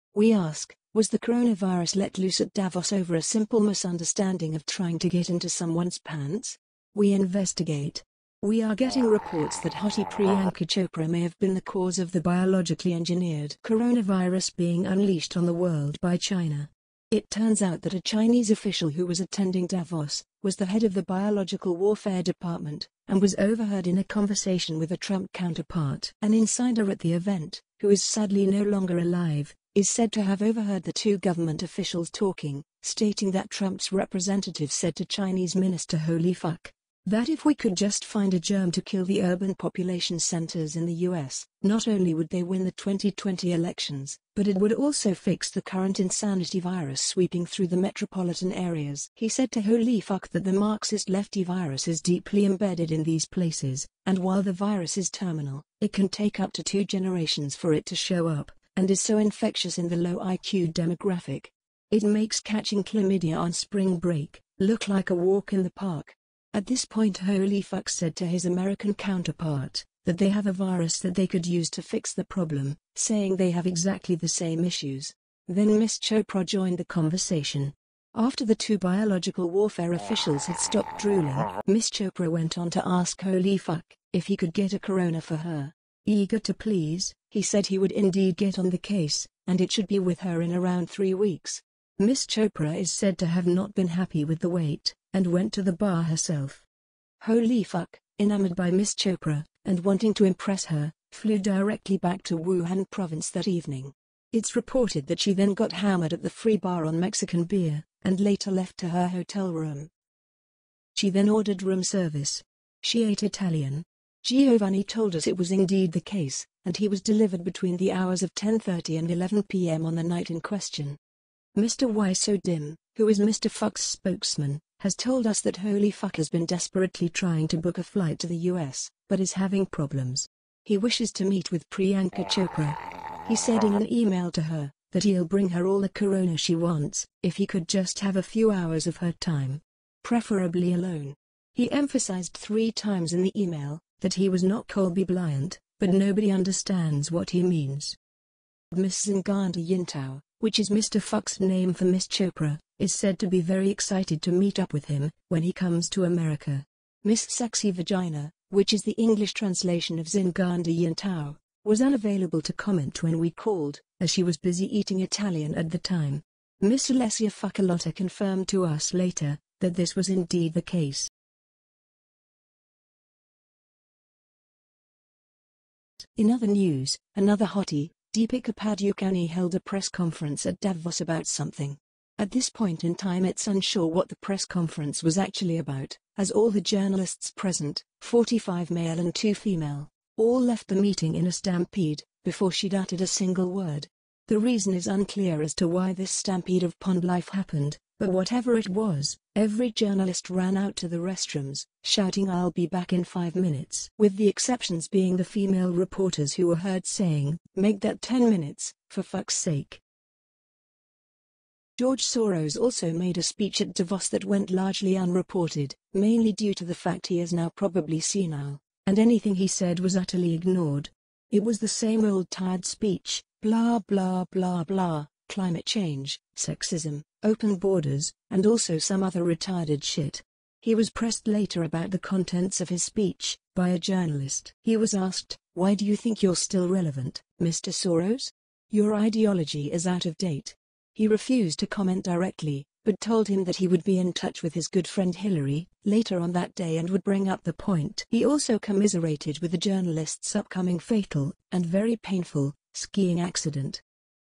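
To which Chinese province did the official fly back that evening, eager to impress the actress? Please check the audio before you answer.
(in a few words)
Wuhan.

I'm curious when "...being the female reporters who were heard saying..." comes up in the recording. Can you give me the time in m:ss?
3:24.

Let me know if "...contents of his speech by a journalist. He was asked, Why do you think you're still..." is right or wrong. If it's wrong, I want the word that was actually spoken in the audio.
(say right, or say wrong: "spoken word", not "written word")
right.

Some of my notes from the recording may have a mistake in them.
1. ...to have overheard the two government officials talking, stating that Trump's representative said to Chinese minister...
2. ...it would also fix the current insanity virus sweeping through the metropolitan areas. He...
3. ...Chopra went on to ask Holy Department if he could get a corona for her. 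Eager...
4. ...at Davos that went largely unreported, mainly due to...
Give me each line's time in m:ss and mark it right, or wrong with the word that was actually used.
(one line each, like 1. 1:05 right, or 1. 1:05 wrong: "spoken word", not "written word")
1. 0:30 right
2. 0:44 right
3. 1:21 wrong: "Fuck", not "Department"
4. 3:33 right.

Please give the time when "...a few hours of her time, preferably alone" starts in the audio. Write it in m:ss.
2:18.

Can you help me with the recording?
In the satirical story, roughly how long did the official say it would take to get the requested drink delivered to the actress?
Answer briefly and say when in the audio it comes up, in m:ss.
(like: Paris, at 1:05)
3 weeks, at 1:30.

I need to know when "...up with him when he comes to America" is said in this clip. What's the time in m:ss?
2:34.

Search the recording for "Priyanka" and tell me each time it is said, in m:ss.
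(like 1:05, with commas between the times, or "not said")
0:10, 2:11.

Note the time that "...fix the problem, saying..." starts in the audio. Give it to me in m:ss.
1:11.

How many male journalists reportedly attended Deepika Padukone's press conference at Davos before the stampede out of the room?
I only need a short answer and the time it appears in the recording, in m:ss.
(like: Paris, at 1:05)
45, at 3:08.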